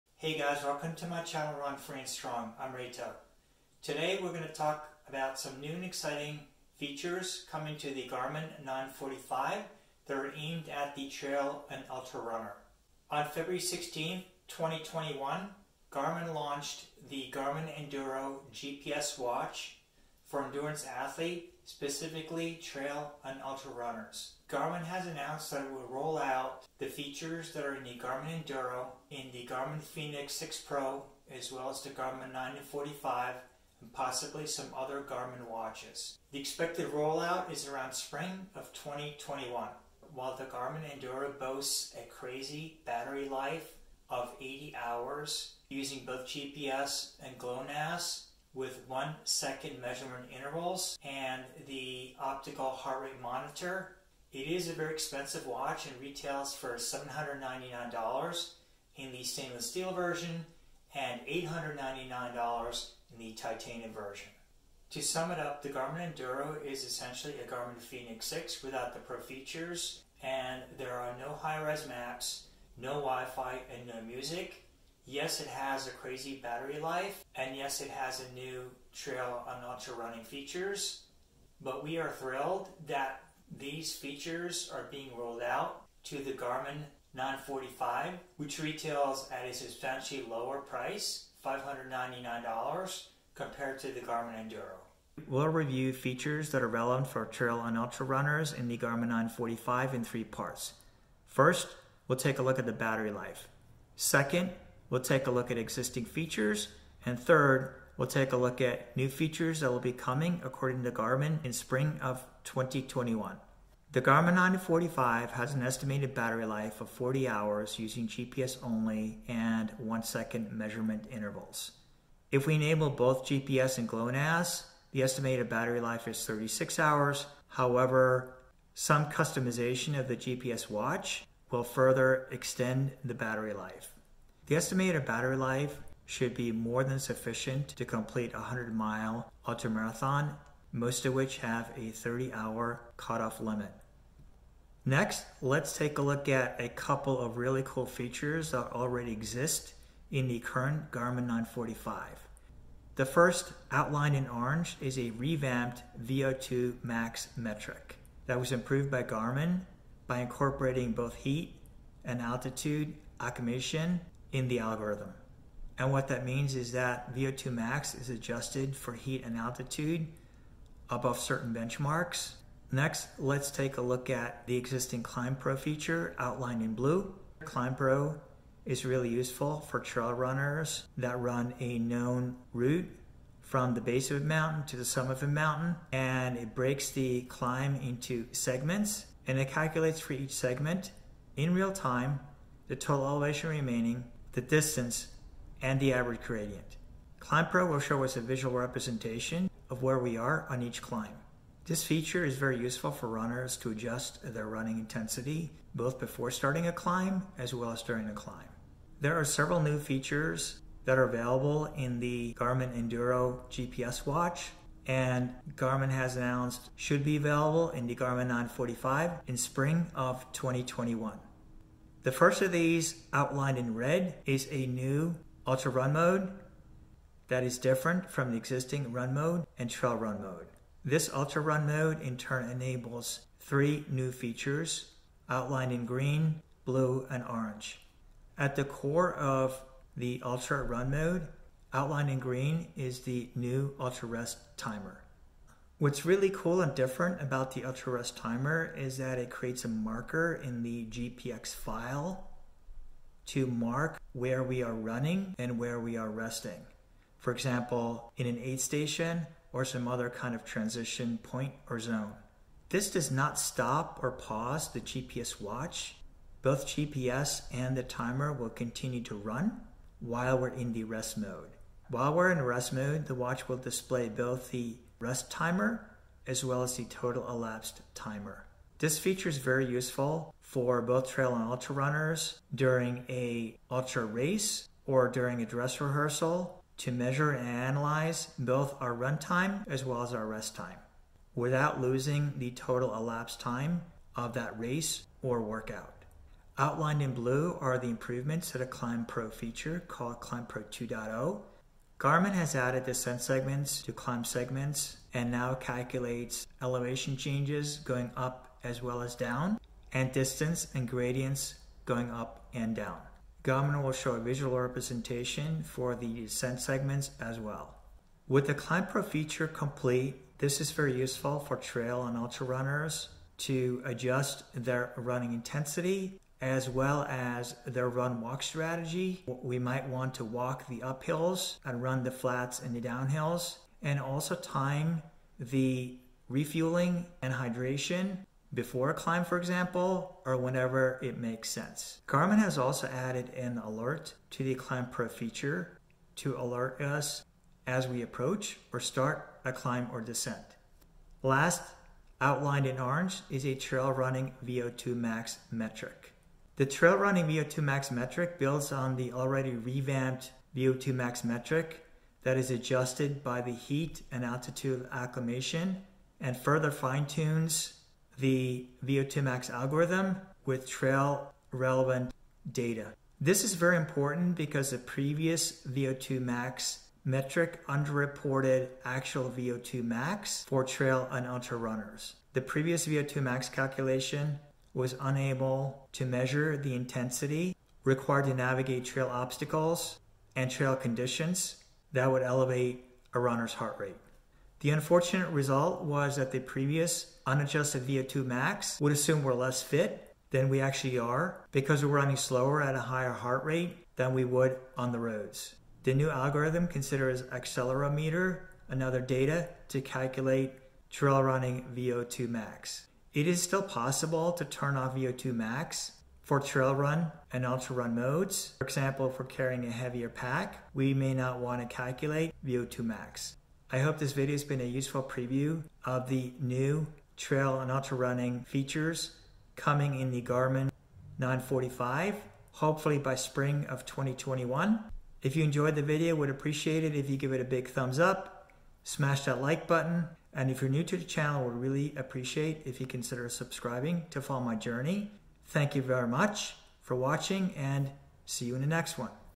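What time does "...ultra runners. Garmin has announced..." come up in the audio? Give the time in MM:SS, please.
00:23.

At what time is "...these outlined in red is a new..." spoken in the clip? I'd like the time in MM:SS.
03:42.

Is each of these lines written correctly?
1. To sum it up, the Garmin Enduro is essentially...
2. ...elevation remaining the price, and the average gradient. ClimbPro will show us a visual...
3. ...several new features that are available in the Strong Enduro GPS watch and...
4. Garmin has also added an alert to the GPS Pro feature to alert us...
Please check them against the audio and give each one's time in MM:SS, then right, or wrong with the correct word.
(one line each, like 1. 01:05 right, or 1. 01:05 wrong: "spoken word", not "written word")
1. 01:04 right
2. 03:13 wrong: "distance", not "price"
3. 03:29 wrong: "Garmin", not "Strong"
4. 05:42 wrong: "Climb", not "GPS".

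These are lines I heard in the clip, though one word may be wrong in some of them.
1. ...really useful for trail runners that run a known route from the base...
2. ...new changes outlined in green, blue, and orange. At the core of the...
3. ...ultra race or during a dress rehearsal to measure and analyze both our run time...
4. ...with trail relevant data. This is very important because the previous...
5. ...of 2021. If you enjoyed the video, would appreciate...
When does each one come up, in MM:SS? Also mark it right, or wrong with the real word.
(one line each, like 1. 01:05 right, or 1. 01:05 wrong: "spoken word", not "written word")
1. 02:58 right
2. 03:53 wrong: "features", not "changes"
3. 04:43 right
4. 06:10 right
5. 07:13 right.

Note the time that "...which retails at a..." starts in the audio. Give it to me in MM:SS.
01:28.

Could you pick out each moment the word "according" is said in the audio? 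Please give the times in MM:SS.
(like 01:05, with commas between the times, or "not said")
01:50.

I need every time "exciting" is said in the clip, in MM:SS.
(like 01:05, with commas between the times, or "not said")
00:05.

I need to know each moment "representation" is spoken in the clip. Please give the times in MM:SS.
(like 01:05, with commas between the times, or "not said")
03:18, 05:14.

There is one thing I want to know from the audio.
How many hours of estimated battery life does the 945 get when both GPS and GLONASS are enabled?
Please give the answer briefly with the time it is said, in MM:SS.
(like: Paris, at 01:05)
36 hours, at 02:06.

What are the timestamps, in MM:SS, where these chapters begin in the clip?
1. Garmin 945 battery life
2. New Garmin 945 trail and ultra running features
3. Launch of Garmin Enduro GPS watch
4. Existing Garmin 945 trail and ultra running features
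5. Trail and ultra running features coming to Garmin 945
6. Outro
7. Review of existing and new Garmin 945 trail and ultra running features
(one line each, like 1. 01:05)
1. 01:54
2. 03:28
3. 00:12
4. 02:24
5. 01:21
6. 07:03
7. 01:35.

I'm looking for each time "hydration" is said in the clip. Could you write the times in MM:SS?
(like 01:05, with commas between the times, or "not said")
05:37.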